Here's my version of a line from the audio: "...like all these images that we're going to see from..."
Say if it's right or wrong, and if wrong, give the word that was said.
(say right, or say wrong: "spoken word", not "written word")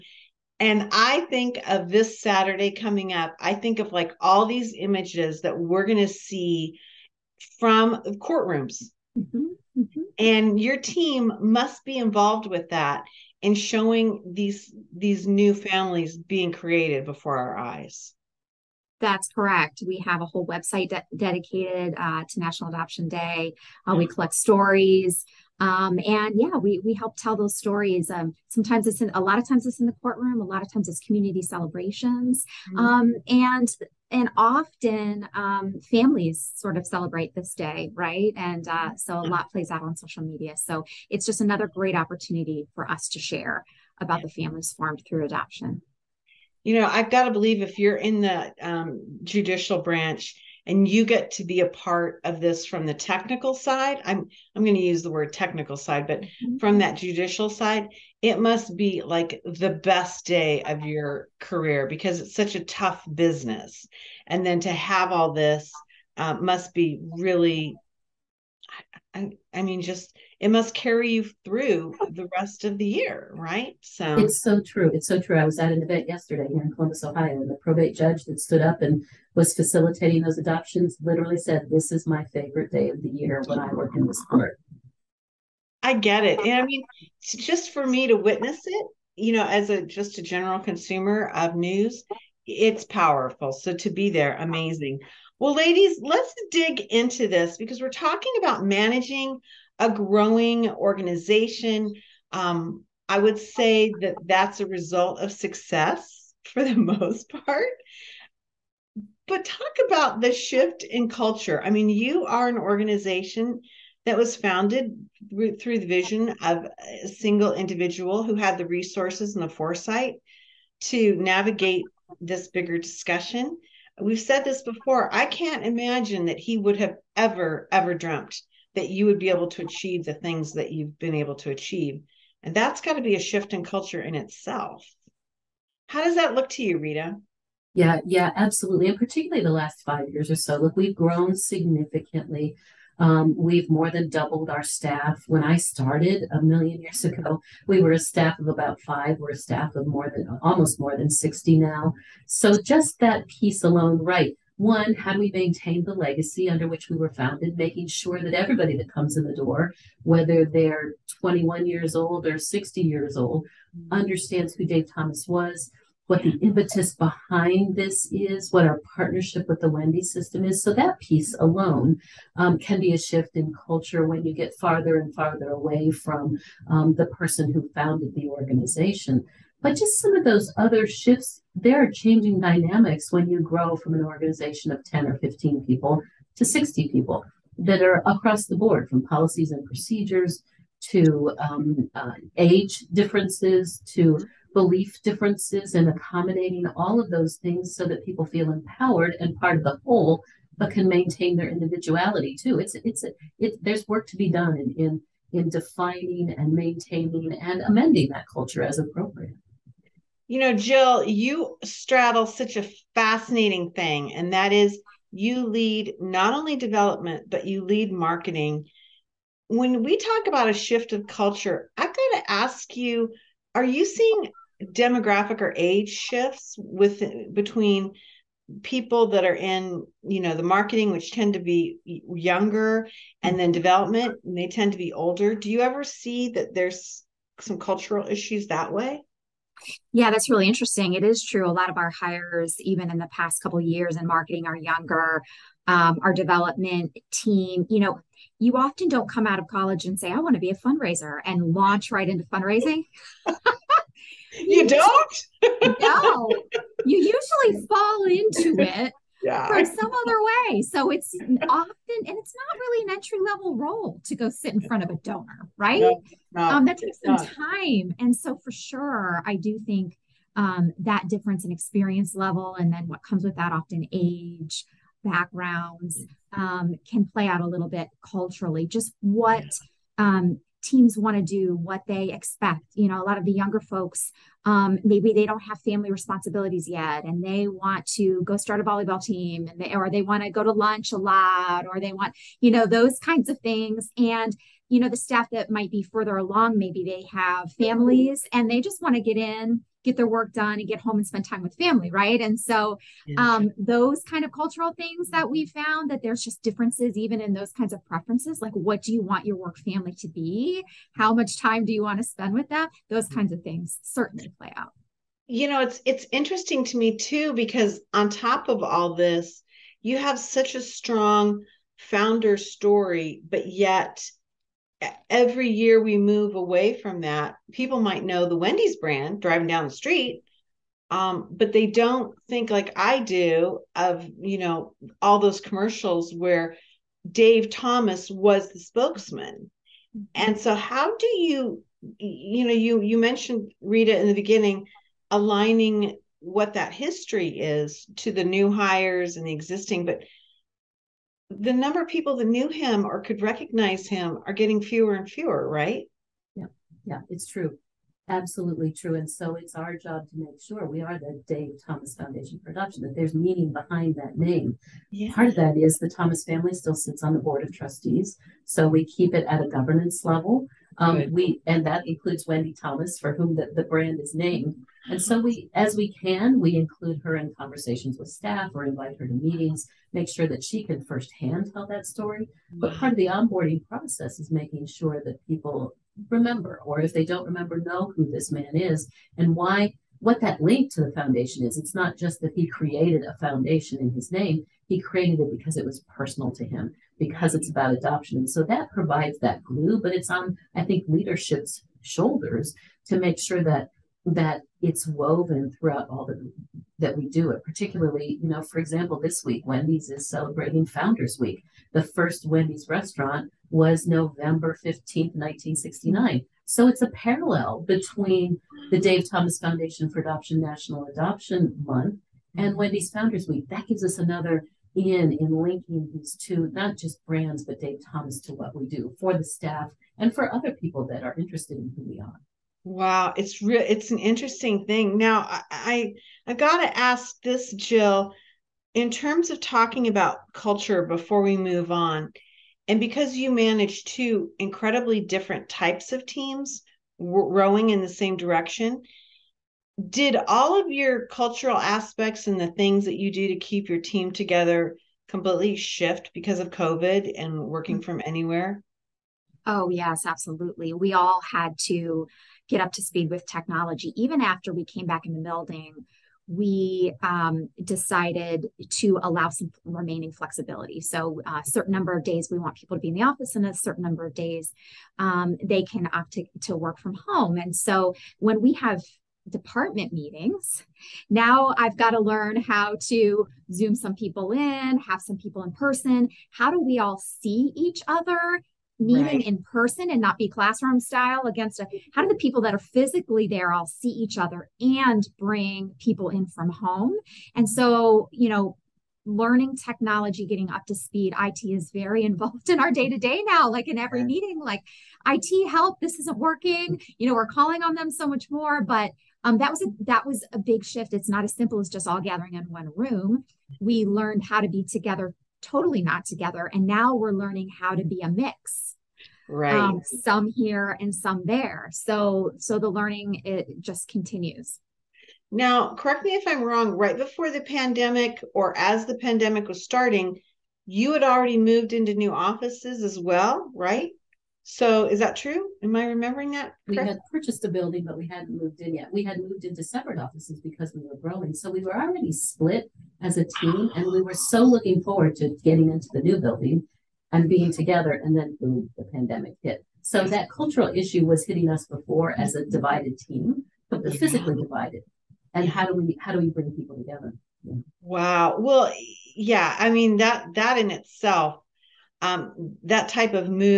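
right.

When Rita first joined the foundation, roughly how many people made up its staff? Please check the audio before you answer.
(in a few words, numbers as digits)
5.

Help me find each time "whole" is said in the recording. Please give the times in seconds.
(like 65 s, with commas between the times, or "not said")
20 s, 199 s.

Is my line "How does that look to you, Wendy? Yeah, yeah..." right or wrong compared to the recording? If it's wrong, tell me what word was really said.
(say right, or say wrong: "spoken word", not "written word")
wrong: "Rita", not "Wendy".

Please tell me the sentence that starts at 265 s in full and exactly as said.
No, um, that takes some time.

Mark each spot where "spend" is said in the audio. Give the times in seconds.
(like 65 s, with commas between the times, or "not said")
301 s, 312 s.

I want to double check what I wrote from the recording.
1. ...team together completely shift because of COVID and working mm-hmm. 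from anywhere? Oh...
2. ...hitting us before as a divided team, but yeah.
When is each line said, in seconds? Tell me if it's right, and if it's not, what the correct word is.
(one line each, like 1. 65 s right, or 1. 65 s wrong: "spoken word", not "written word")
1. 453 s right
2. 551 s right.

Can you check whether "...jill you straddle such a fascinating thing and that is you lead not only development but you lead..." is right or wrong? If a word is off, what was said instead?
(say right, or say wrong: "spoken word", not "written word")
right.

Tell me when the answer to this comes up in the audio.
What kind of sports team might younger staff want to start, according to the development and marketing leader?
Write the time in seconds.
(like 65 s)
288 s.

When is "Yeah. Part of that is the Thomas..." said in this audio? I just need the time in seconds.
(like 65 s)
364 s.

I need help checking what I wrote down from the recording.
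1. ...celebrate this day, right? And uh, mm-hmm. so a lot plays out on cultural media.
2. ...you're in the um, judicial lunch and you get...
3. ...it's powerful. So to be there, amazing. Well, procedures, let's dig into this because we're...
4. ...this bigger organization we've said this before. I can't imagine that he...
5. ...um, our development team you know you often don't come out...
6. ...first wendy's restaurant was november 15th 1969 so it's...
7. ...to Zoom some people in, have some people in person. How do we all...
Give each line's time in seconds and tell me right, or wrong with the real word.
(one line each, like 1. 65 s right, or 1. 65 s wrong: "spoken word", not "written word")
1. 36 s wrong: "social", not "cultural"
2. 47 s wrong: "branch", not "lunch"
3. 92 s wrong: "ladies", not "procedures"
4. 122 s wrong: "discussion", not "organization"
5. 245 s right
6. 411 s right
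7. 482 s right.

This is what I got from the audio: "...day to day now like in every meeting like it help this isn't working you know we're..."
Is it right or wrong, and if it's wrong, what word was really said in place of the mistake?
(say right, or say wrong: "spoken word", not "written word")
right.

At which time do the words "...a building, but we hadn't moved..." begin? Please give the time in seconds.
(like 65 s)
537 s.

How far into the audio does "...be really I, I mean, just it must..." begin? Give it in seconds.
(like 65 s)
66 s.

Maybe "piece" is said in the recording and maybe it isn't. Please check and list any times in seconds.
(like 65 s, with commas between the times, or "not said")
153 s, 170 s.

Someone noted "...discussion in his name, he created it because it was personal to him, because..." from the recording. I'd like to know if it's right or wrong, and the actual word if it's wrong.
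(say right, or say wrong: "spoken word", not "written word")
wrong: "foundation", not "discussion".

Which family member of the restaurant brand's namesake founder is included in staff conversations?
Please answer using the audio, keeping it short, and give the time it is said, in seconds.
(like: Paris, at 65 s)
Wendy Thomas, at 372 s.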